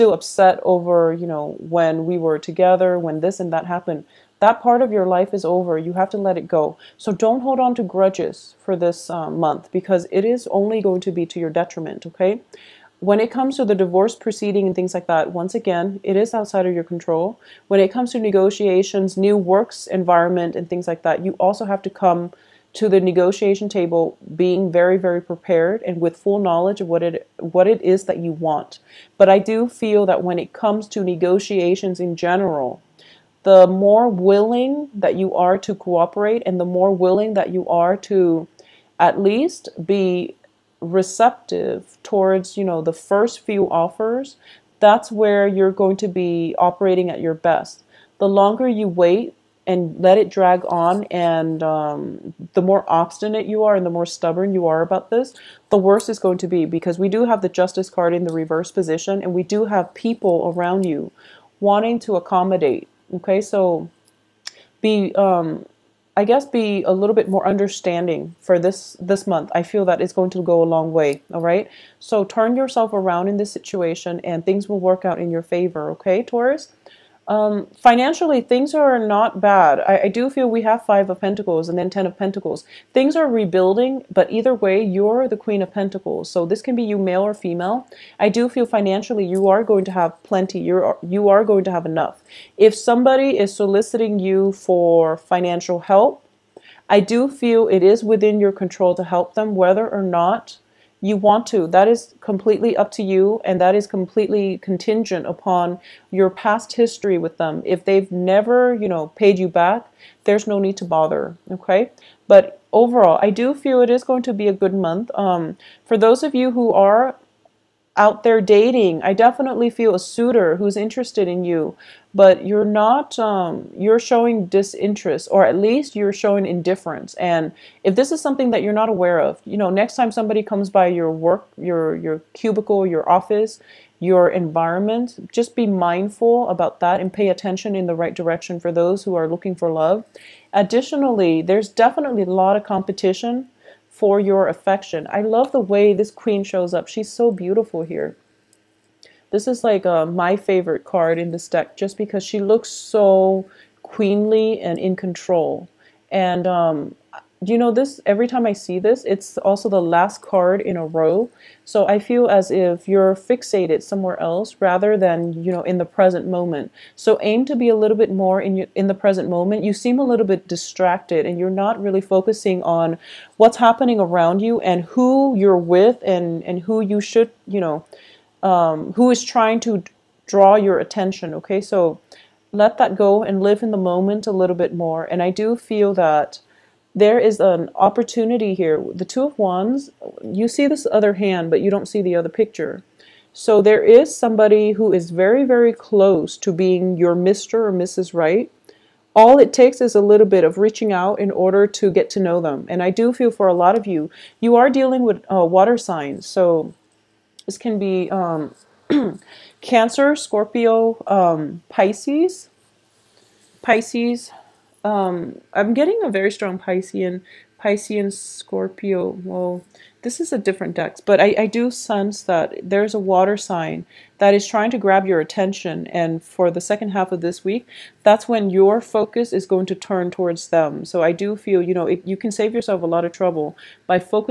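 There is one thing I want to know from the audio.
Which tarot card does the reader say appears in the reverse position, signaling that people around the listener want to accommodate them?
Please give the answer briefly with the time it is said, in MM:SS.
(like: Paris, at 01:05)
Justice, at 00:57.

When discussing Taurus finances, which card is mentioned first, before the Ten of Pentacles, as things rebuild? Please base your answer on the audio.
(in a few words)
Five of Pentacles.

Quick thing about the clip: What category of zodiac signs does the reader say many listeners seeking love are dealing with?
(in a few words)
water signs.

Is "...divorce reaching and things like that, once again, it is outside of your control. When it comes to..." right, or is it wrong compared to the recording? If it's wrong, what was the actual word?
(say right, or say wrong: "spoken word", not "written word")
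wrong: "proceeding", not "reaching".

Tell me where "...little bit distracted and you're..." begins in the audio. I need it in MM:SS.
02:50.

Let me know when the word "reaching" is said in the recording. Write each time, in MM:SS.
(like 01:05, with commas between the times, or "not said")
03:20.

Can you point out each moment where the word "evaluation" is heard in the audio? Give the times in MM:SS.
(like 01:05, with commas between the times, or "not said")
not said.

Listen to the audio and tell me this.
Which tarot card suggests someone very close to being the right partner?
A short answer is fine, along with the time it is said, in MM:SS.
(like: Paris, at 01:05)
Two of Wands, at 03:08.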